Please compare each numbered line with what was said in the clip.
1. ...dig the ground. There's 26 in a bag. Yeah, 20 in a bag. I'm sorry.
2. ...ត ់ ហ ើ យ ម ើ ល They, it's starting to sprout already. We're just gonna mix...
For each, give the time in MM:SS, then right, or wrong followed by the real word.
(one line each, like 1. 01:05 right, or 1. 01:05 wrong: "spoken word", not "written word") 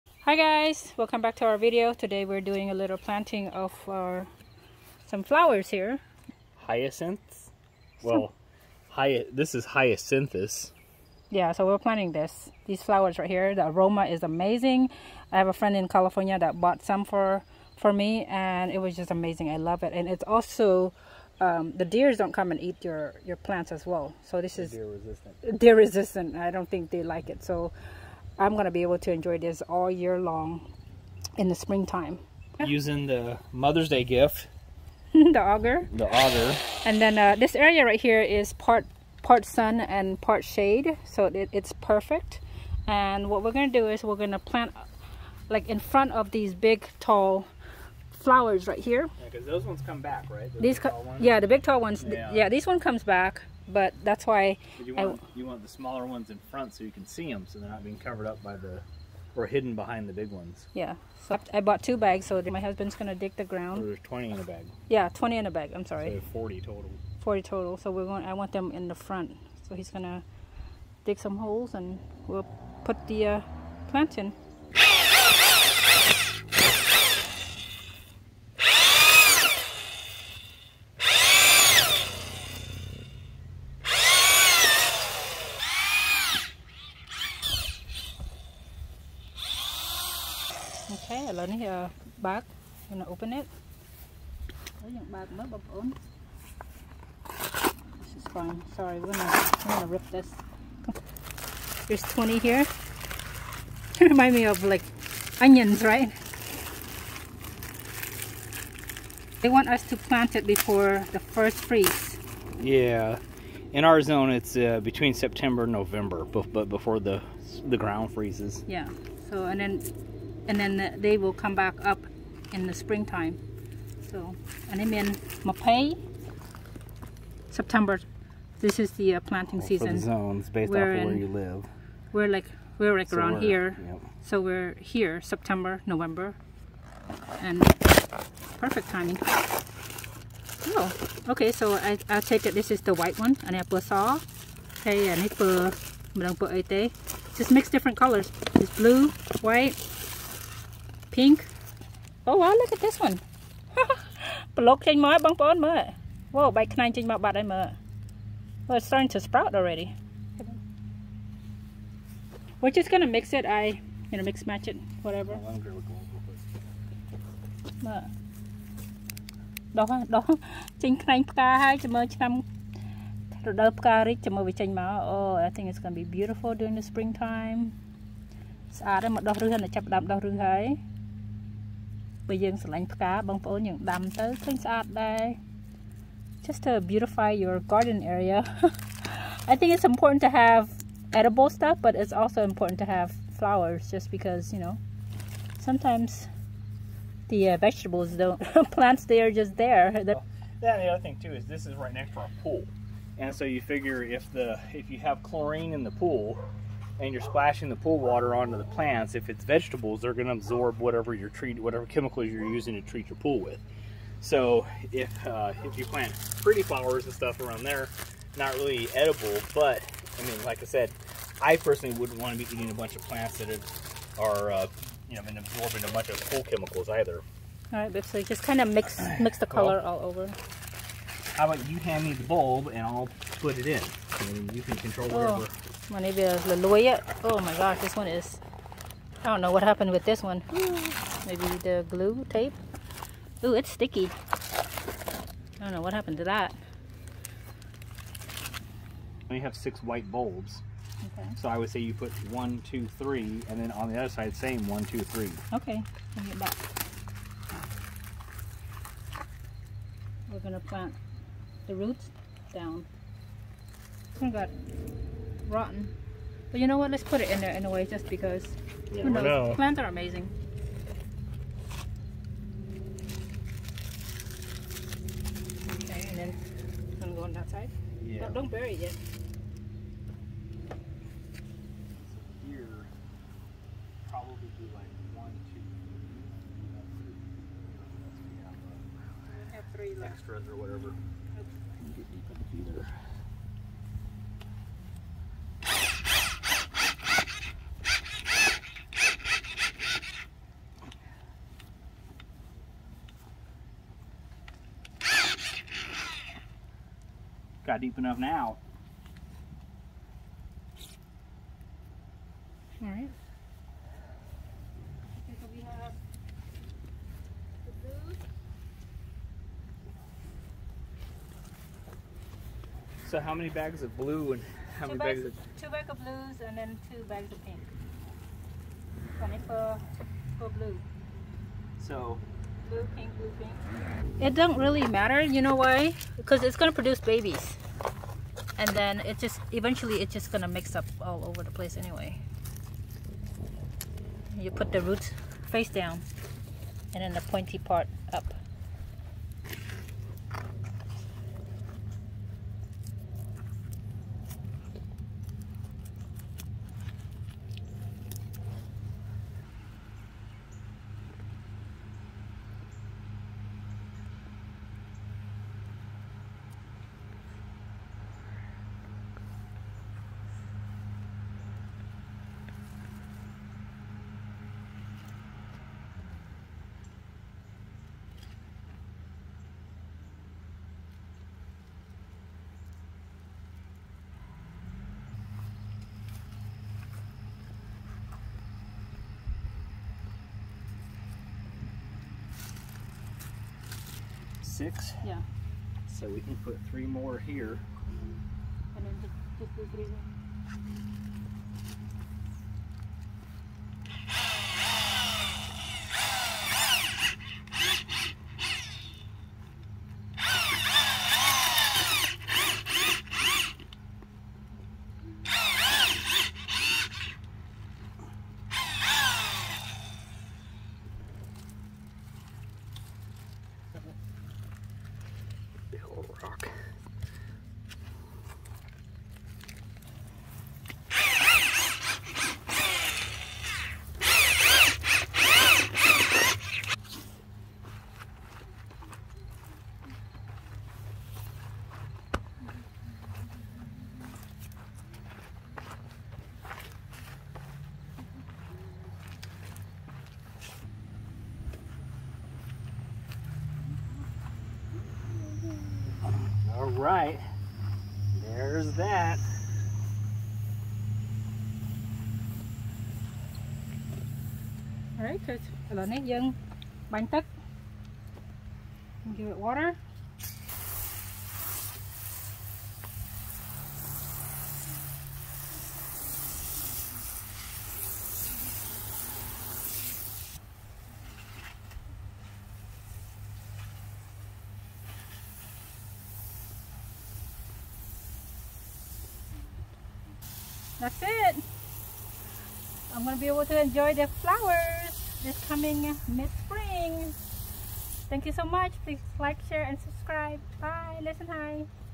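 1. 01:03 wrong: "20", not "26"
2. 02:37 wrong: "Well", not "They".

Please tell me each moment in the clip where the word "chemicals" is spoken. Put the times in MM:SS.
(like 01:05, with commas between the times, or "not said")
03:31, 03:46.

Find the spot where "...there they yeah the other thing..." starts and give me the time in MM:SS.
03:19.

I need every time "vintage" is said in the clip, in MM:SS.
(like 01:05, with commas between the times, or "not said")
not said.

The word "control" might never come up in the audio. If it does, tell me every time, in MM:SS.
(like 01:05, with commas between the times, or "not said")
03:54.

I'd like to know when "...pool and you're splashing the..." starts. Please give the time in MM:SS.
03:26.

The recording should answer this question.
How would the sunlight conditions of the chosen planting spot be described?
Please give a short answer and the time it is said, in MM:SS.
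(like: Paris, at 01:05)
Part sun and part shade, at 00:39.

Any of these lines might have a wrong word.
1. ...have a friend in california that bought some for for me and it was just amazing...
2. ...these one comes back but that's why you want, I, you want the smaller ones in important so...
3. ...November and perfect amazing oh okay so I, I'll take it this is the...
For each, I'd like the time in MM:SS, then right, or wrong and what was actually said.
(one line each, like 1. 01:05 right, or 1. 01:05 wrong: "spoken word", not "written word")
1. 00:15 right
2. 00:52 wrong: "front", not "important"
3. 02:15 wrong: "timing", not "amazing".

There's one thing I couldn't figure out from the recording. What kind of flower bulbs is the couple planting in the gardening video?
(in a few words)
Hyacinths.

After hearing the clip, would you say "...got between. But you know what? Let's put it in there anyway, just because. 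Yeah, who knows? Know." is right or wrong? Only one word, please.
wrong.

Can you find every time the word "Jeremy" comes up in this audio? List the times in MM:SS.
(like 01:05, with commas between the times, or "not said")
not said.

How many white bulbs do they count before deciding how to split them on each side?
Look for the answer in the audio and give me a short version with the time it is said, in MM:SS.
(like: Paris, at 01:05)
6, at 04:09.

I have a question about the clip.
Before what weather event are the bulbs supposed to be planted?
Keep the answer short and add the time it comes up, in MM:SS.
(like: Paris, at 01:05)
The first freeze, at 01:51.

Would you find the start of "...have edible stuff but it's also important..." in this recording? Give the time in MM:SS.
03:10.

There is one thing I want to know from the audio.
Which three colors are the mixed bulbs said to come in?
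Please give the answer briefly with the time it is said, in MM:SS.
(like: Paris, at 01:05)
Blue, white, pink, at 02:28.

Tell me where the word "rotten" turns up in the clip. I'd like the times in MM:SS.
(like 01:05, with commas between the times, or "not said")
04:25.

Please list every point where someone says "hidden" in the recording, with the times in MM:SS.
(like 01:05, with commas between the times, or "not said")
00:59.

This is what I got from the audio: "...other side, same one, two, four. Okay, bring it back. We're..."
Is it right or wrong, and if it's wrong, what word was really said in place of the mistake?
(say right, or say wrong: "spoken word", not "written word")
wrong: "three", not "four".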